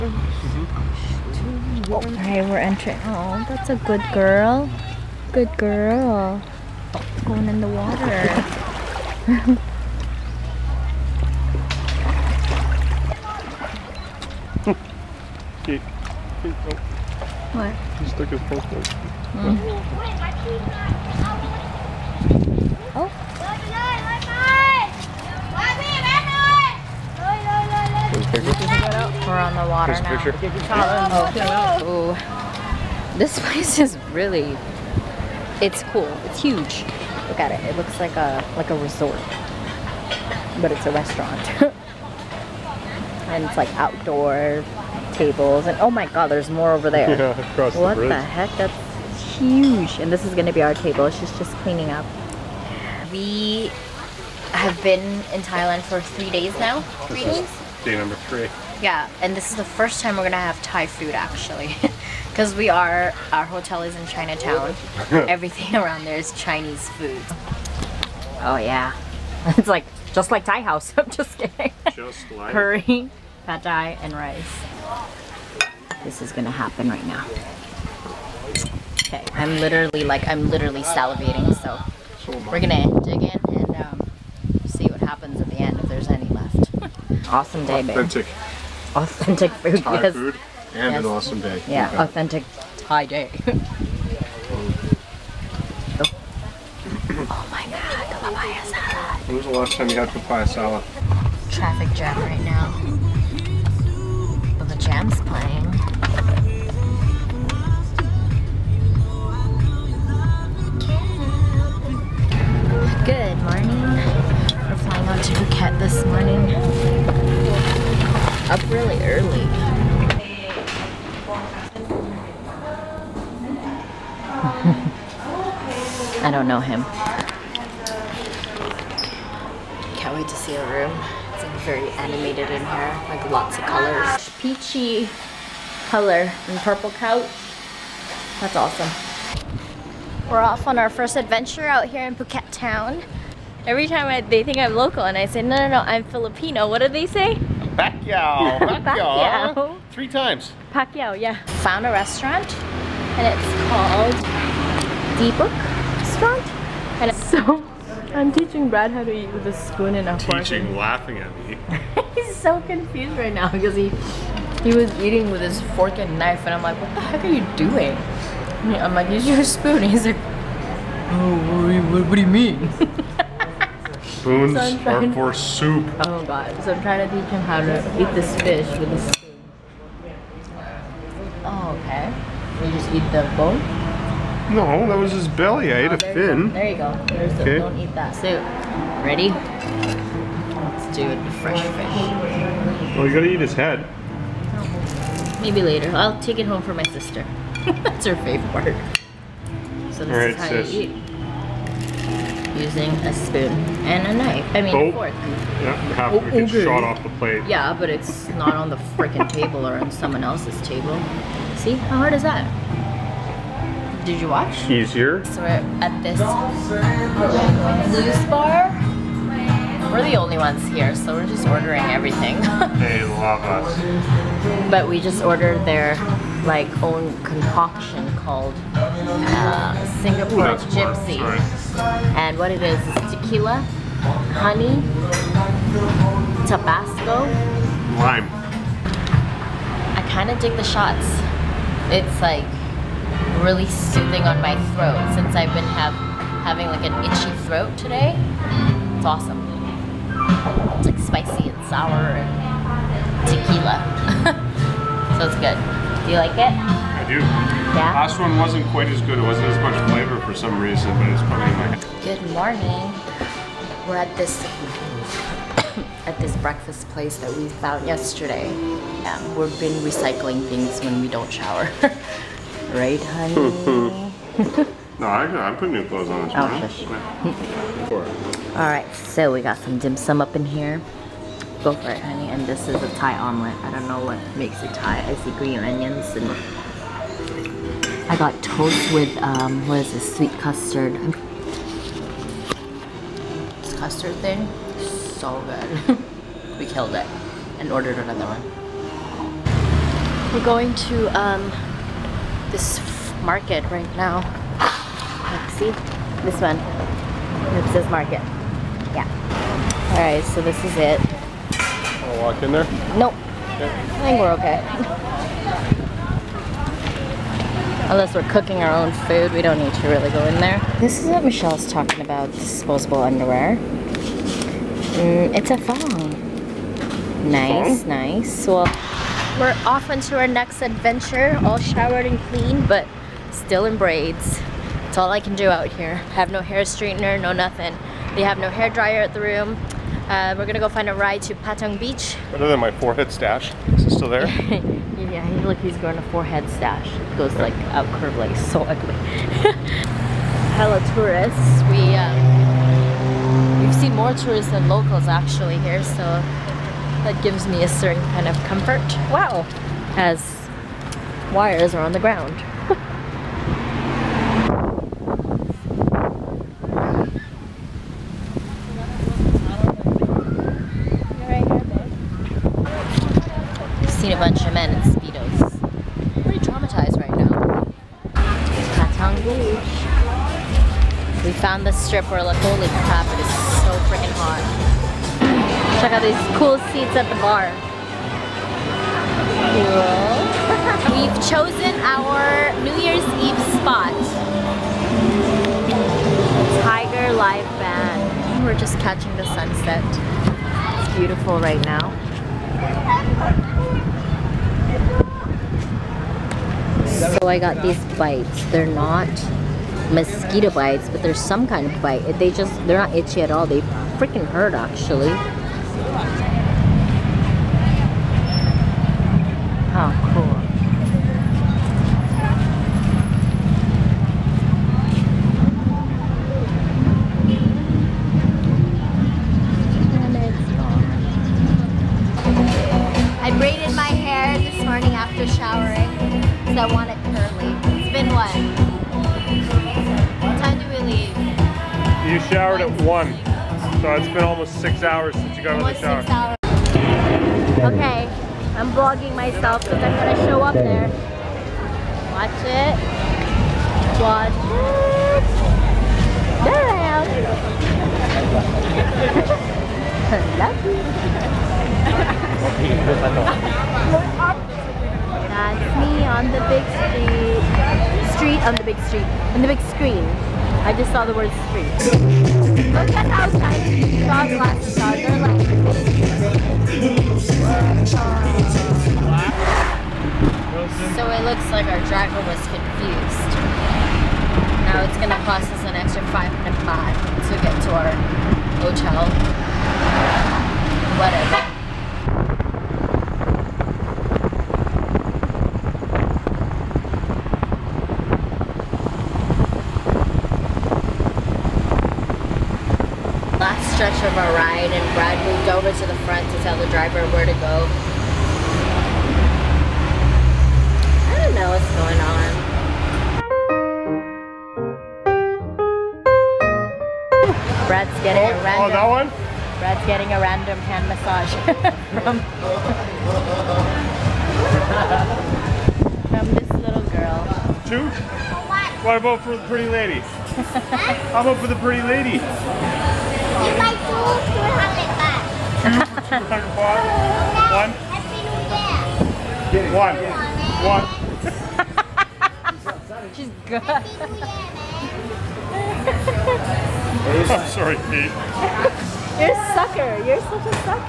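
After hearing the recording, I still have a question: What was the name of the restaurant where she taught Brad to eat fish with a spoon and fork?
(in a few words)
Deepak Restaurant.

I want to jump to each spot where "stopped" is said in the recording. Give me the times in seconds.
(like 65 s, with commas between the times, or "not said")
not said.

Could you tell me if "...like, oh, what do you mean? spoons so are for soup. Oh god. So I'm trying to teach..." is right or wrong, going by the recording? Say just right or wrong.
right.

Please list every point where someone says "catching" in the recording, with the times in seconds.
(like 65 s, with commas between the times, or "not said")
398 s.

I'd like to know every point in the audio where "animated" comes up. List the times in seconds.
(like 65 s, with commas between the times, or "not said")
131 s.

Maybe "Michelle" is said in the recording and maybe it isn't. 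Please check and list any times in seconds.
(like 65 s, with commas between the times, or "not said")
321 s.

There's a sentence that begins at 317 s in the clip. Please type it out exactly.
Unless we're cooking our own food, we don't need to really go in there.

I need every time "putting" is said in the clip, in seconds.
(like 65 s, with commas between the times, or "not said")
275 s.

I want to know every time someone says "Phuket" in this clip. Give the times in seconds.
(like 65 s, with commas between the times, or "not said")
115 s, 142 s.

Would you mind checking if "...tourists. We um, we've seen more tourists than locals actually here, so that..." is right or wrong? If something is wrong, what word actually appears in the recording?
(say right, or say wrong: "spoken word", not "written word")
right.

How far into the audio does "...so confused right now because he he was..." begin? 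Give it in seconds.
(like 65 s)
162 s.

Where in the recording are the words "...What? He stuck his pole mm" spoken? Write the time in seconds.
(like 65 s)
17 s.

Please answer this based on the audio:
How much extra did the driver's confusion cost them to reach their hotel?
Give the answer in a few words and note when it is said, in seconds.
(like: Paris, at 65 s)
500 baht, at 486 s.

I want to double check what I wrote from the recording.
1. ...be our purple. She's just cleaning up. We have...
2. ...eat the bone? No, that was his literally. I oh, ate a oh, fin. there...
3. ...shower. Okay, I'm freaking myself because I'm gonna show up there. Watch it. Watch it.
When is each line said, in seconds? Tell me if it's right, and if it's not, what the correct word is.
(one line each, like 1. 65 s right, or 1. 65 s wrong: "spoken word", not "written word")
1. 50 s wrong: "table", not "purple"
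2. 182 s wrong: "belly", not "literally"
3. 446 s wrong: "vlogging", not "freaking".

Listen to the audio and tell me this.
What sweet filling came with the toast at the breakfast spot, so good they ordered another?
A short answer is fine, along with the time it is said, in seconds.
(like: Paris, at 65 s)
Sweet custard, at 290 s.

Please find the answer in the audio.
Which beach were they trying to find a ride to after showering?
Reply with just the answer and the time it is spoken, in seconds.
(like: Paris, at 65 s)
Patong Beach, at 341 s.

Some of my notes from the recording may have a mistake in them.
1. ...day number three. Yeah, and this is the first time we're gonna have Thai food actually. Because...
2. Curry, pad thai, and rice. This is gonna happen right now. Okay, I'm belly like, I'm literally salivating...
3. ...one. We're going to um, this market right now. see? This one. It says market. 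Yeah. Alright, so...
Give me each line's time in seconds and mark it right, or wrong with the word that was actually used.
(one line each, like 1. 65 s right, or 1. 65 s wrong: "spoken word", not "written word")
1. 57 s right
2. 72 s wrong: "literally", not "belly"
3. 298 s right.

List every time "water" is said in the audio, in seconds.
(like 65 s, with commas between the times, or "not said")
7 s, 29 s.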